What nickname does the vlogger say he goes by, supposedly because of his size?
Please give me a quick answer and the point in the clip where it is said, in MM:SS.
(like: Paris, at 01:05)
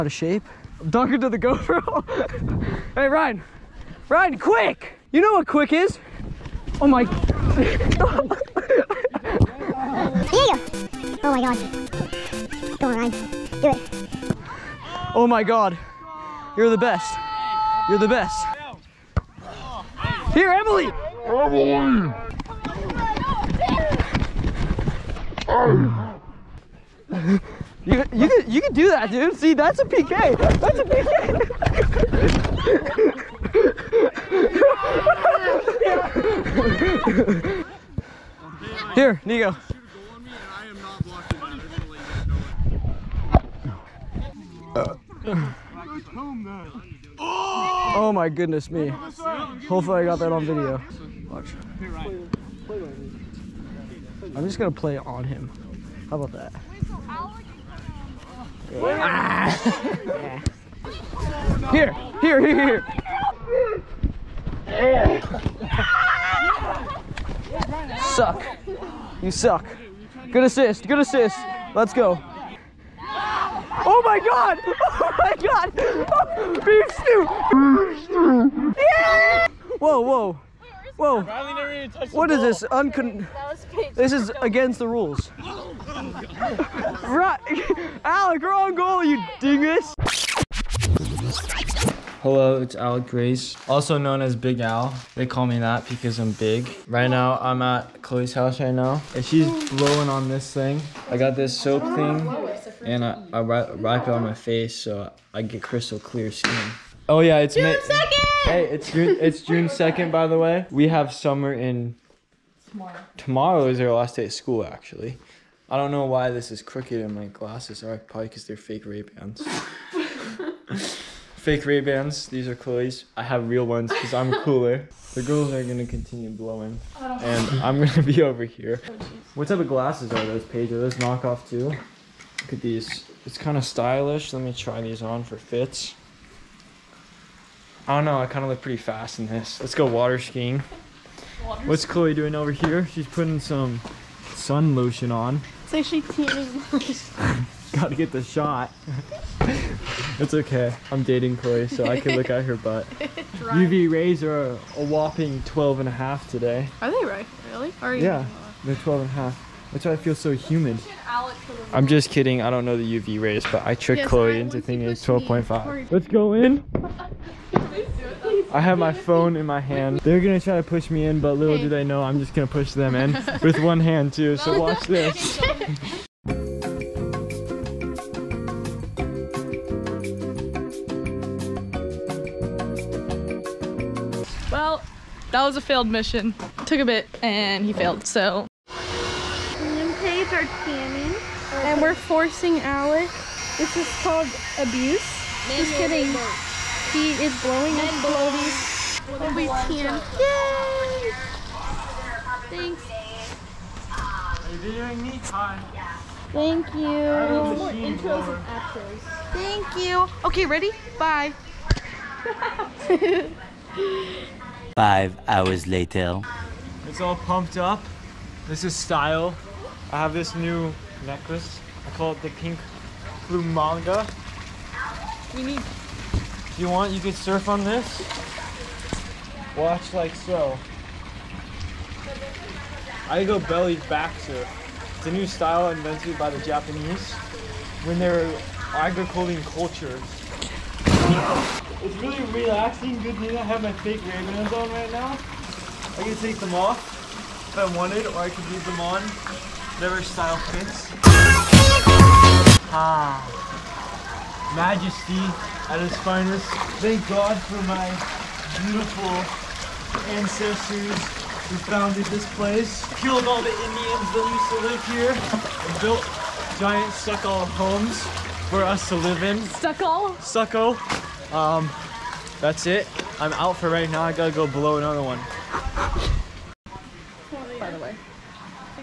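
Big Al, at 01:34.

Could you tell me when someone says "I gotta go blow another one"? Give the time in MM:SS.
04:34.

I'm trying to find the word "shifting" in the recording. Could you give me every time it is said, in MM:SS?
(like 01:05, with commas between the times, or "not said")
not said.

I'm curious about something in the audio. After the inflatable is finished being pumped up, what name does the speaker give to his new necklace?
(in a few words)
pink blue manga.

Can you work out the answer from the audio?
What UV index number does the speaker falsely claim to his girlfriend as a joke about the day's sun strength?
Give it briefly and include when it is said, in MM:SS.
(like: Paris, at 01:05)
12.5, at 02:45.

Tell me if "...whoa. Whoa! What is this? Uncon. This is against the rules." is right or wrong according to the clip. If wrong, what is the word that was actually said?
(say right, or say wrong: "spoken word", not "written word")
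right.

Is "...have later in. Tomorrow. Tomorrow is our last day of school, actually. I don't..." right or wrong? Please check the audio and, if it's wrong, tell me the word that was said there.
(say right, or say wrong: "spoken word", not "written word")
wrong: "summer", not "later".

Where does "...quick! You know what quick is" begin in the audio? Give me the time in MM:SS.
00:04.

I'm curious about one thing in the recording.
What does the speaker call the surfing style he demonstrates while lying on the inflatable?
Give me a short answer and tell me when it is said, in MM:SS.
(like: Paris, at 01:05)
belly back surf, at 03:53.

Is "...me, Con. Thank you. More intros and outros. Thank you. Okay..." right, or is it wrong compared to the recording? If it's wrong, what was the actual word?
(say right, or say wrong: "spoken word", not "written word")
right.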